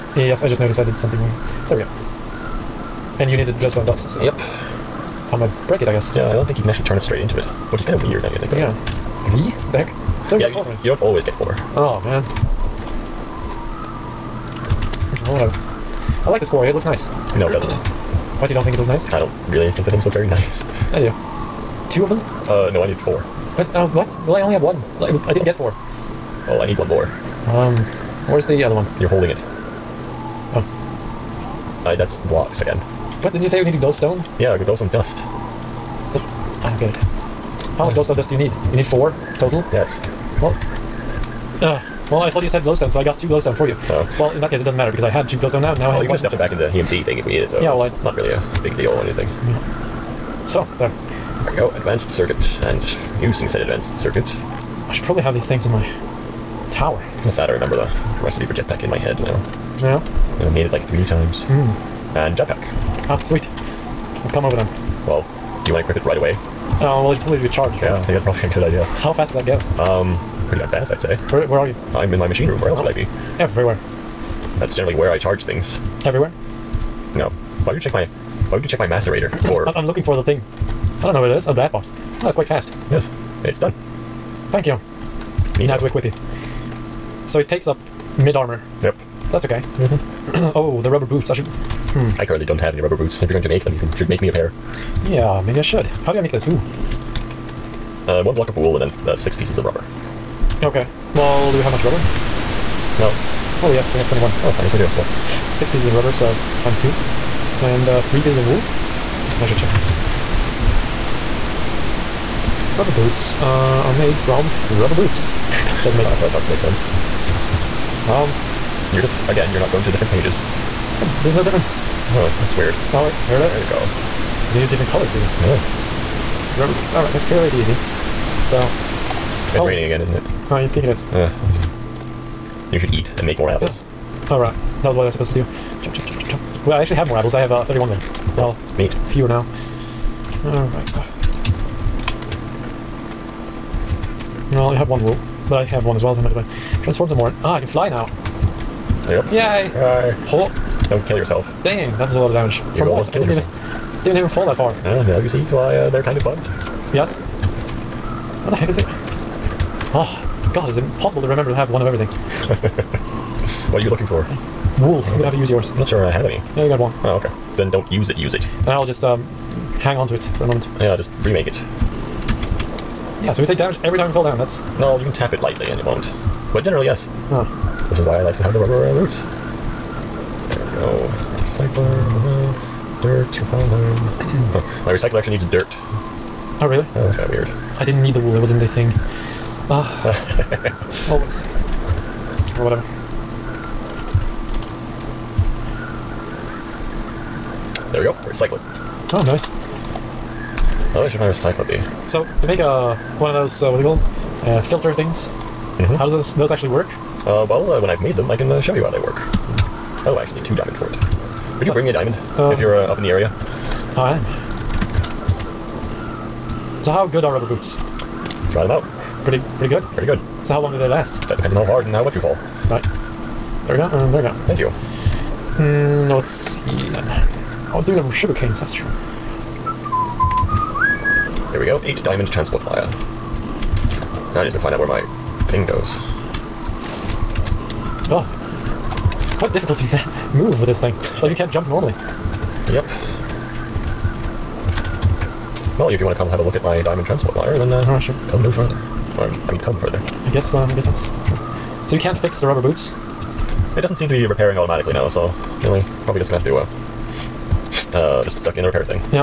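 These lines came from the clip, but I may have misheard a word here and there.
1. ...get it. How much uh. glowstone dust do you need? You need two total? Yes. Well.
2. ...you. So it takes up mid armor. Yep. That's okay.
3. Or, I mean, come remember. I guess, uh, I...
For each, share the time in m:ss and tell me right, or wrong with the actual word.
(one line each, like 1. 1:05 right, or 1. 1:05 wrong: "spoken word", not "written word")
1. 0:36 wrong: "four", not "two"
2. 1:26 right
3. 4:09 wrong: "further", not "remember".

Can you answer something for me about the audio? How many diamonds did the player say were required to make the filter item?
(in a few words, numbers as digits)
2.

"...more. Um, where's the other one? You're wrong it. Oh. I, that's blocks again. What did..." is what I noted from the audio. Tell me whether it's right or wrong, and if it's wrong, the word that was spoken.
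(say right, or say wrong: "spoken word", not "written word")
wrong: "holding", not "wrong".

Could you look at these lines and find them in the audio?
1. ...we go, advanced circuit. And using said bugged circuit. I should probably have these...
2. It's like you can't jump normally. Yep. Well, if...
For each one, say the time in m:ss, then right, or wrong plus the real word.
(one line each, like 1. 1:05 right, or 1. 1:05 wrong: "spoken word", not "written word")
1. 0:51 wrong: "advanced", not "bugged"
2. 4:01 right.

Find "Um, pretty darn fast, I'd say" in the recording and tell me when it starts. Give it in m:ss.
1:09.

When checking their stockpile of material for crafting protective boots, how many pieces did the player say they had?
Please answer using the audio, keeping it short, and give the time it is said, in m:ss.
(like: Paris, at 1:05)
21, at 1:43.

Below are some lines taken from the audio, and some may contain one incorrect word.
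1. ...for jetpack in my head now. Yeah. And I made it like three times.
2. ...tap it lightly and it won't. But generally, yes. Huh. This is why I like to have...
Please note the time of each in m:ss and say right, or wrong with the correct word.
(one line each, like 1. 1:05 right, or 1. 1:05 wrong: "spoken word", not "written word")
1. 0:58 right
2. 2:55 right.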